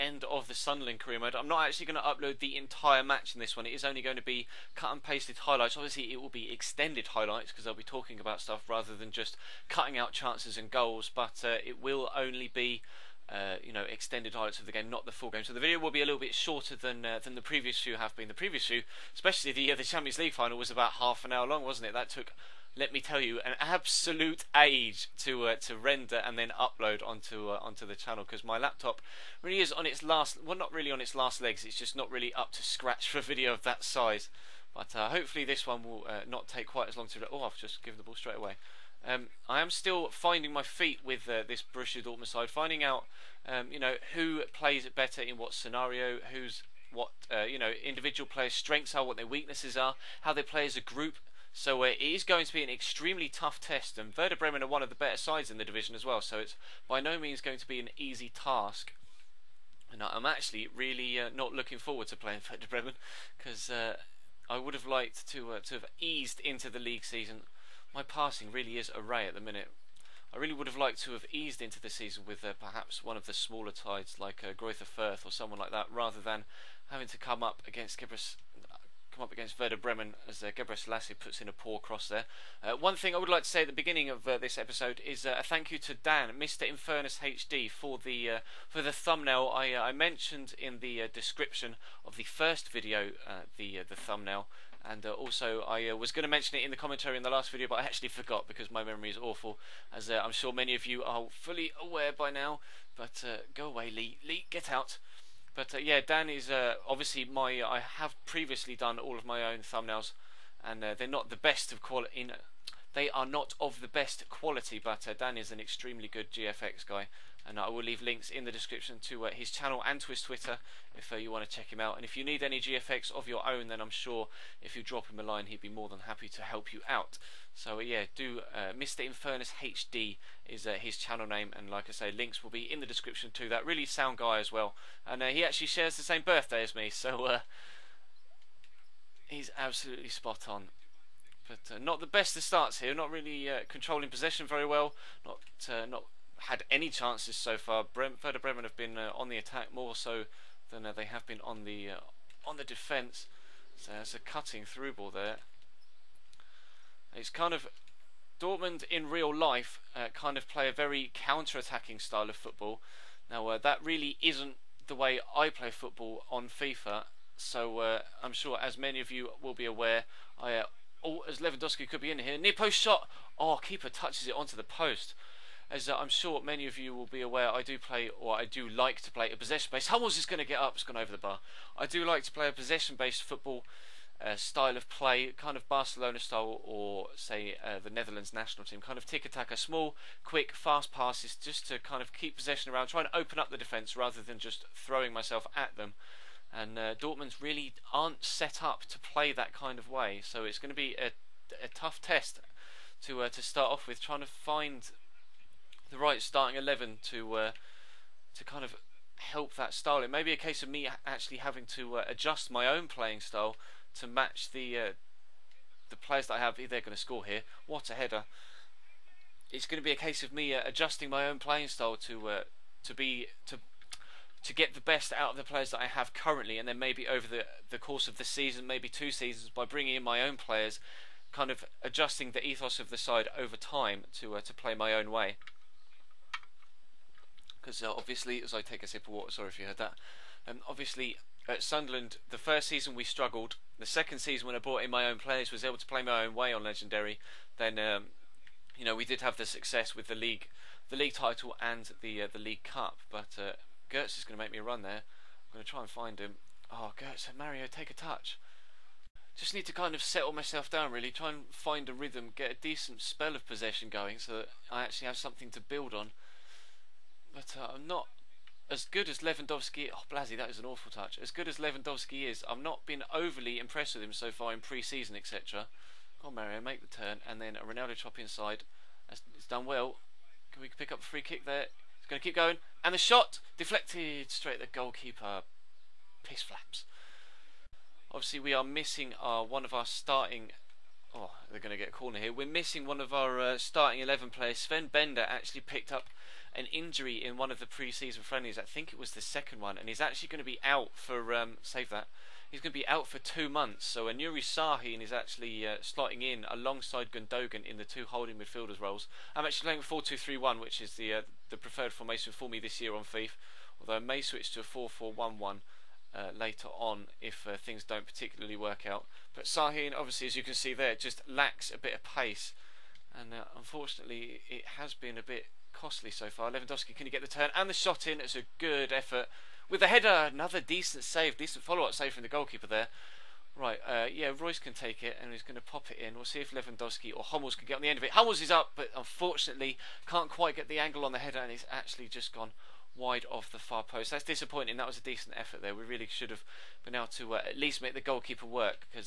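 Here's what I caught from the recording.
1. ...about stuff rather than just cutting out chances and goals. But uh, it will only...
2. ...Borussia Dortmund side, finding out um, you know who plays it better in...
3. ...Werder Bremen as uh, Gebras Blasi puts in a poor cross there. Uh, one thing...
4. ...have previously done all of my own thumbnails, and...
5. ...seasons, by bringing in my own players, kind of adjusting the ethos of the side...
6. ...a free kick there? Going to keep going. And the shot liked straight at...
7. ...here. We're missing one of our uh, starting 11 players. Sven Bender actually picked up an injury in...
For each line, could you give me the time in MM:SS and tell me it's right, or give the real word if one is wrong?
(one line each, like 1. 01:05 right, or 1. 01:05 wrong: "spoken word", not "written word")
1. 00:08 right
2. 00:41 right
3. 01:19 wrong: "Lassie", not "Blasi"
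4. 01:47 right
5. 03:49 right
6. 04:40 wrong: "deflected", not "liked"
7. 04:52 right.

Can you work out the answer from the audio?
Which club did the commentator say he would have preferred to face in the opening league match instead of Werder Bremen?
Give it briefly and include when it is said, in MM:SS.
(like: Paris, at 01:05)
Fürth, at 01:14.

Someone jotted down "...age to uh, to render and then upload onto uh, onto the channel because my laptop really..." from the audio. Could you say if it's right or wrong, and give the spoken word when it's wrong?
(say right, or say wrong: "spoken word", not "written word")
right.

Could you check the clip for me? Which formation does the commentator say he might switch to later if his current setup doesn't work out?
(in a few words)
4-4-1-1.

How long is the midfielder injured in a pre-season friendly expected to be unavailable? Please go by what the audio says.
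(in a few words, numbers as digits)
2 months.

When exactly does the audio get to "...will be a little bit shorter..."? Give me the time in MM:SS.
00:15.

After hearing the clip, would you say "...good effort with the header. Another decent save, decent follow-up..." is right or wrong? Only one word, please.
right.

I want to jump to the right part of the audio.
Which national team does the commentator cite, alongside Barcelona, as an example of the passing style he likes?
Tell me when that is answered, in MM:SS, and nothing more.
03:07.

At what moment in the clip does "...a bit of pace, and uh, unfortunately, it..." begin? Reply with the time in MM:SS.
05:21.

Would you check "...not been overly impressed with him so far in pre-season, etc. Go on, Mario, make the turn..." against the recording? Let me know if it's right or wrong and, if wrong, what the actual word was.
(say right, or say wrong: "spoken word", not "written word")
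right.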